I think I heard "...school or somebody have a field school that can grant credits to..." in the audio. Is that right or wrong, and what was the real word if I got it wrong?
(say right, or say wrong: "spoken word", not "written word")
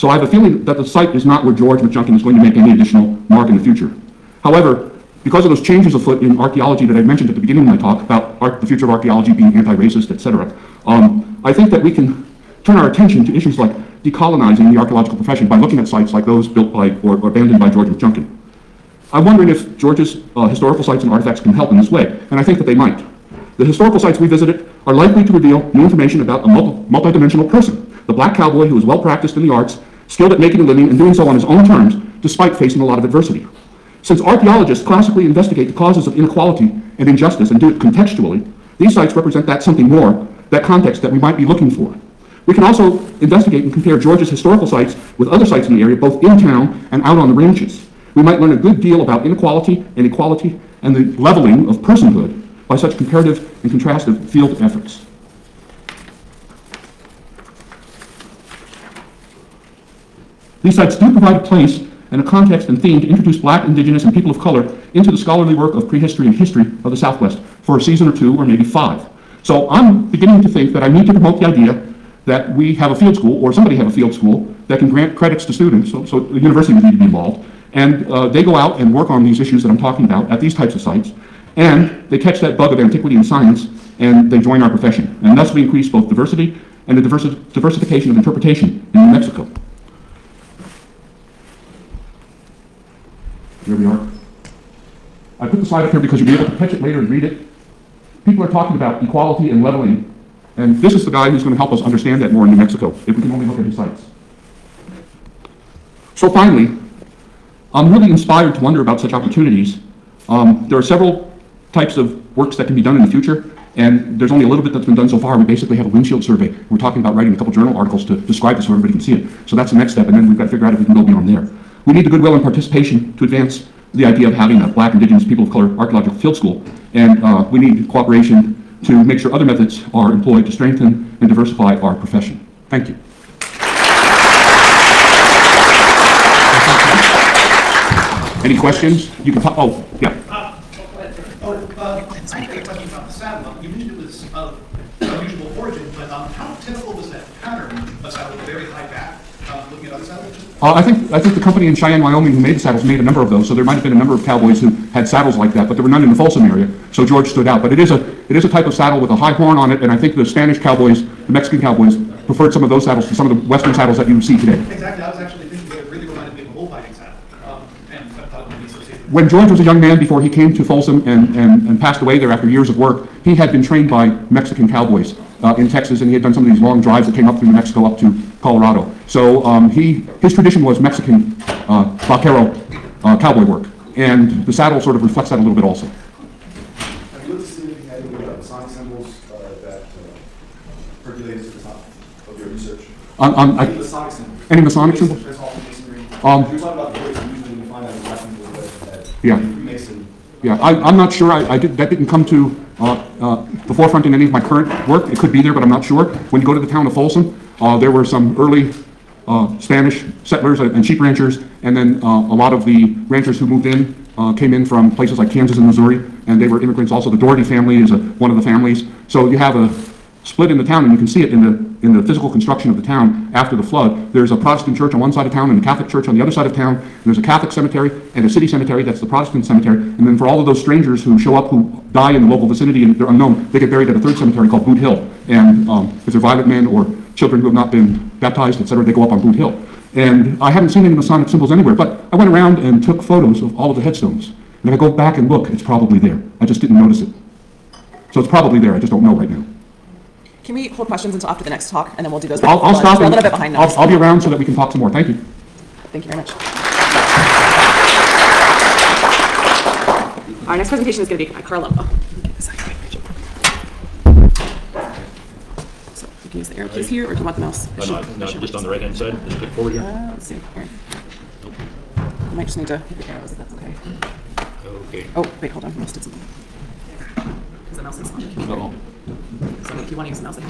right.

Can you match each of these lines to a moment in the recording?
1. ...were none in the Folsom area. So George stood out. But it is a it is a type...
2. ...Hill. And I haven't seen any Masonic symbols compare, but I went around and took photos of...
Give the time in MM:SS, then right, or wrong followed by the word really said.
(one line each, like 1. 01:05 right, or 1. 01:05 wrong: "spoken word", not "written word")
1. 02:35 right
2. 03:59 wrong: "anywhere", not "compare".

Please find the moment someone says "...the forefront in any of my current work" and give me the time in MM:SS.
03:23.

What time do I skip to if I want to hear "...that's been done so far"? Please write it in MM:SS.
01:54.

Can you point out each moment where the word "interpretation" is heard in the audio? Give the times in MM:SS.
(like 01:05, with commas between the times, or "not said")
01:28.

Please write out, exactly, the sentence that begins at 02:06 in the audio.
And uh, we need cooperation to make sure other methods are employed to strengthen and diversify our profession.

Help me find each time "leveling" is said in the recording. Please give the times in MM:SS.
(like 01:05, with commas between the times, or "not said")
00:51, 01:39.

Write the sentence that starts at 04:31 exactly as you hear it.
I might just need to hit the arrows if that's okay.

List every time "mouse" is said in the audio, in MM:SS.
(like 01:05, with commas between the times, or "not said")
04:27, 04:37.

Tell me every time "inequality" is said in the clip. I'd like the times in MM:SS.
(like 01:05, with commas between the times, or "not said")
00:36, 00:49.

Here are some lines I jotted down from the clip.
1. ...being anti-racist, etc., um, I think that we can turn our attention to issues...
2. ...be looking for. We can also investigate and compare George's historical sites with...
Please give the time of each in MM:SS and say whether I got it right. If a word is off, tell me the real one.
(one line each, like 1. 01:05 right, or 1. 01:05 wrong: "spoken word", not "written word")
1. 00:09 right
2. 00:41 right.